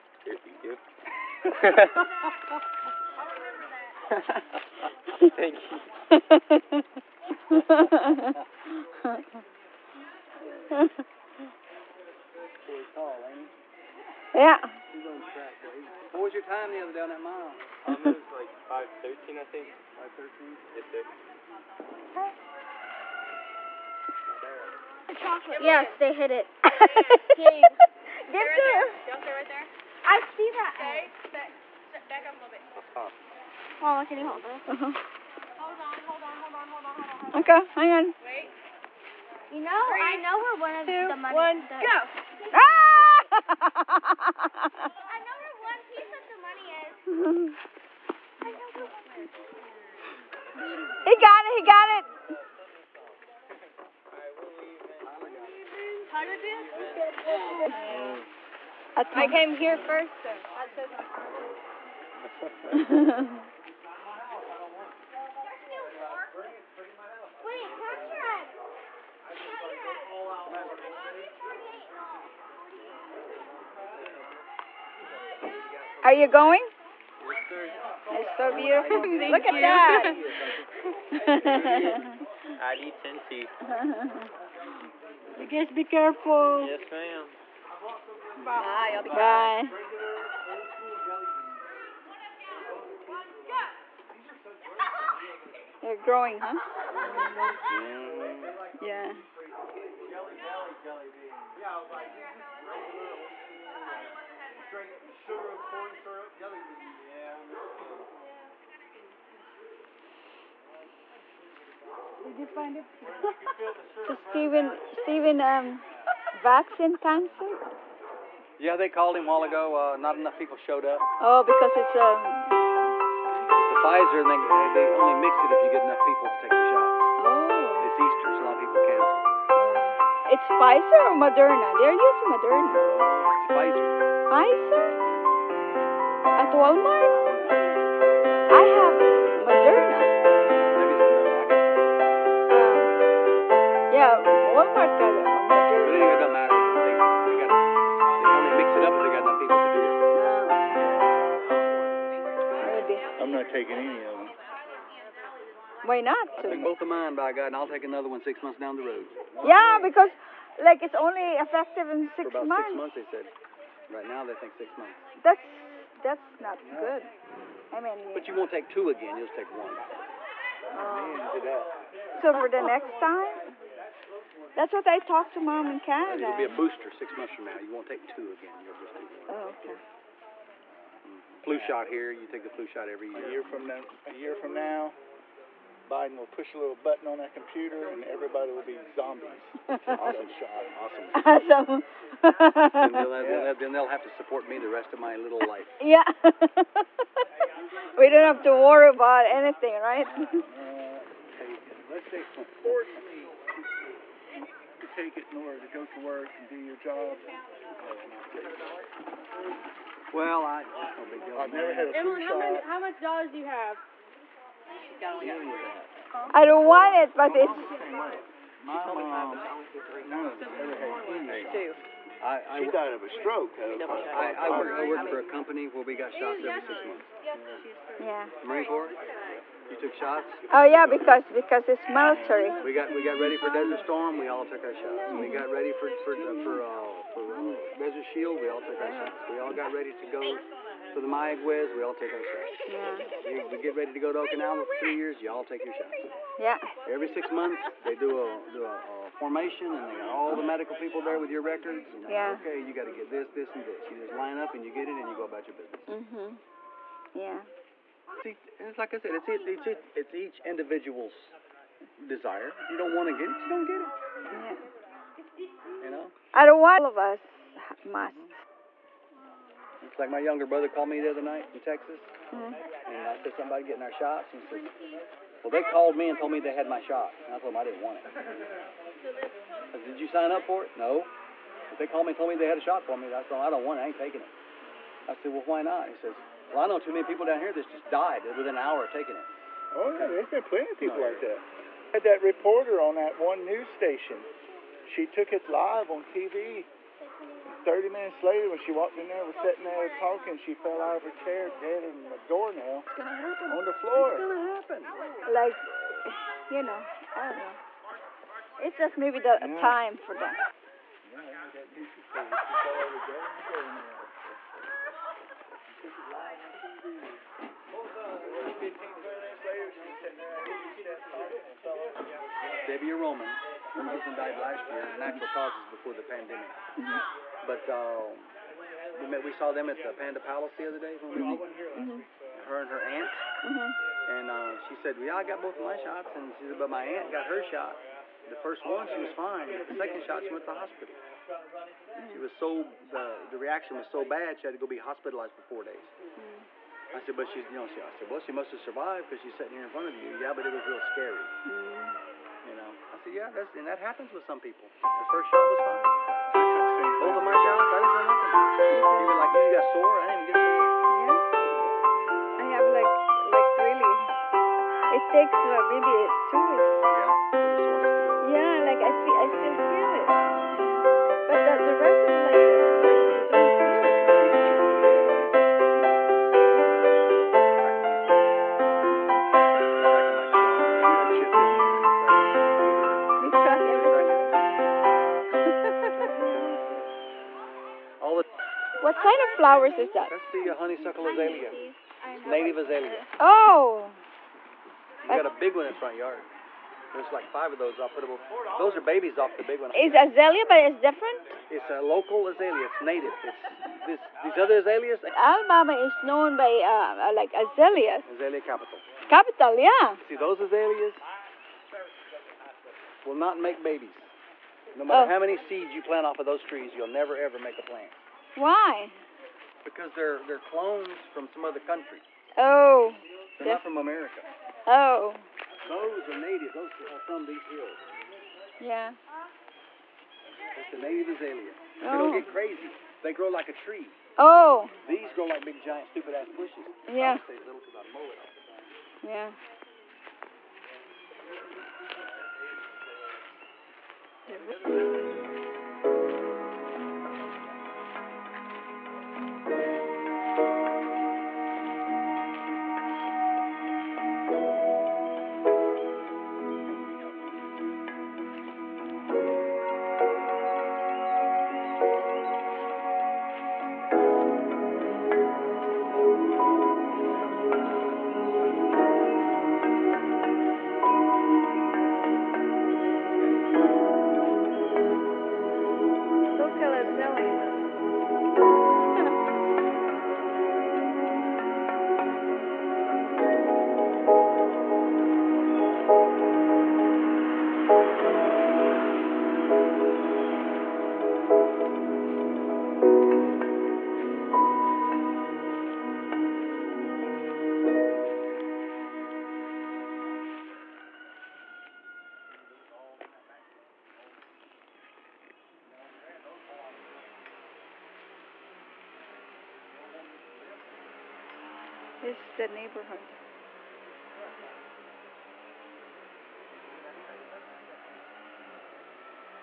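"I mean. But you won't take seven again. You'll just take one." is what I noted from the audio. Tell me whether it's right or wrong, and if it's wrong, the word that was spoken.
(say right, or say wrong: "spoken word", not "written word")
wrong: "two", not "seven".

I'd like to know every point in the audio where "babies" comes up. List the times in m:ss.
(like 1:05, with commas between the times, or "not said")
6:38, 6:53.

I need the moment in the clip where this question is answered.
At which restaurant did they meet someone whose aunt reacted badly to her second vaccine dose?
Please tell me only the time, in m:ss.
5:30.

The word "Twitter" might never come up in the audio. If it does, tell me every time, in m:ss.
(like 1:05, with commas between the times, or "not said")
not said.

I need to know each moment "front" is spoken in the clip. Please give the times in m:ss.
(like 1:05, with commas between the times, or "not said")
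5:49, 6:35.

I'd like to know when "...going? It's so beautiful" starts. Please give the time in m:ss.
1:16.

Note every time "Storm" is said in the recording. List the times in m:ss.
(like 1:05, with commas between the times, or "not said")
3:53.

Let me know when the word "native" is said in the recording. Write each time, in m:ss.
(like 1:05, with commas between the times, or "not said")
6:32, 6:42, 7:06, 7:10.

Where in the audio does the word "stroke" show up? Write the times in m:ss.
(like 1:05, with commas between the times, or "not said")
3:43.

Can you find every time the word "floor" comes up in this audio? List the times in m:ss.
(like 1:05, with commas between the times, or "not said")
5:03.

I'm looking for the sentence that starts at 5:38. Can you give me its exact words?
The first one, she was fine.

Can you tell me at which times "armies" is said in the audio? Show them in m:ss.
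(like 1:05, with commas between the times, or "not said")
not said.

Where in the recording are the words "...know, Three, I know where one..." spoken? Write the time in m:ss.
0:39.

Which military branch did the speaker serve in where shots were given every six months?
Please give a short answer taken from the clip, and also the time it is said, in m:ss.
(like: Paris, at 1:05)
Marine Corps, at 3:48.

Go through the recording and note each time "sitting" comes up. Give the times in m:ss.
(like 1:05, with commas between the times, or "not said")
4:59, 5:49.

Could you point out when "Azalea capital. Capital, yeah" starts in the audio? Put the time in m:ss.
6:48.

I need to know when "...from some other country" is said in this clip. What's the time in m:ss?
7:00.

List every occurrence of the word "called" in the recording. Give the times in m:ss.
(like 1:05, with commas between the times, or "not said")
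1:58, 4:30, 4:35, 4:41.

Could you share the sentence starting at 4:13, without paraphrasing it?
You just line up and you get it, and you go about your business.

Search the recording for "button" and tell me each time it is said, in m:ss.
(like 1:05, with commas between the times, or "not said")
3:06.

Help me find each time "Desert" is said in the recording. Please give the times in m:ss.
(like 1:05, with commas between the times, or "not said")
3:53, 3:57.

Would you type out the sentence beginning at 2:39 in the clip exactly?
Yeah, because like it's only effective in six months.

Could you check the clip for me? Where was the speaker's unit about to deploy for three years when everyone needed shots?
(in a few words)
Okinawa.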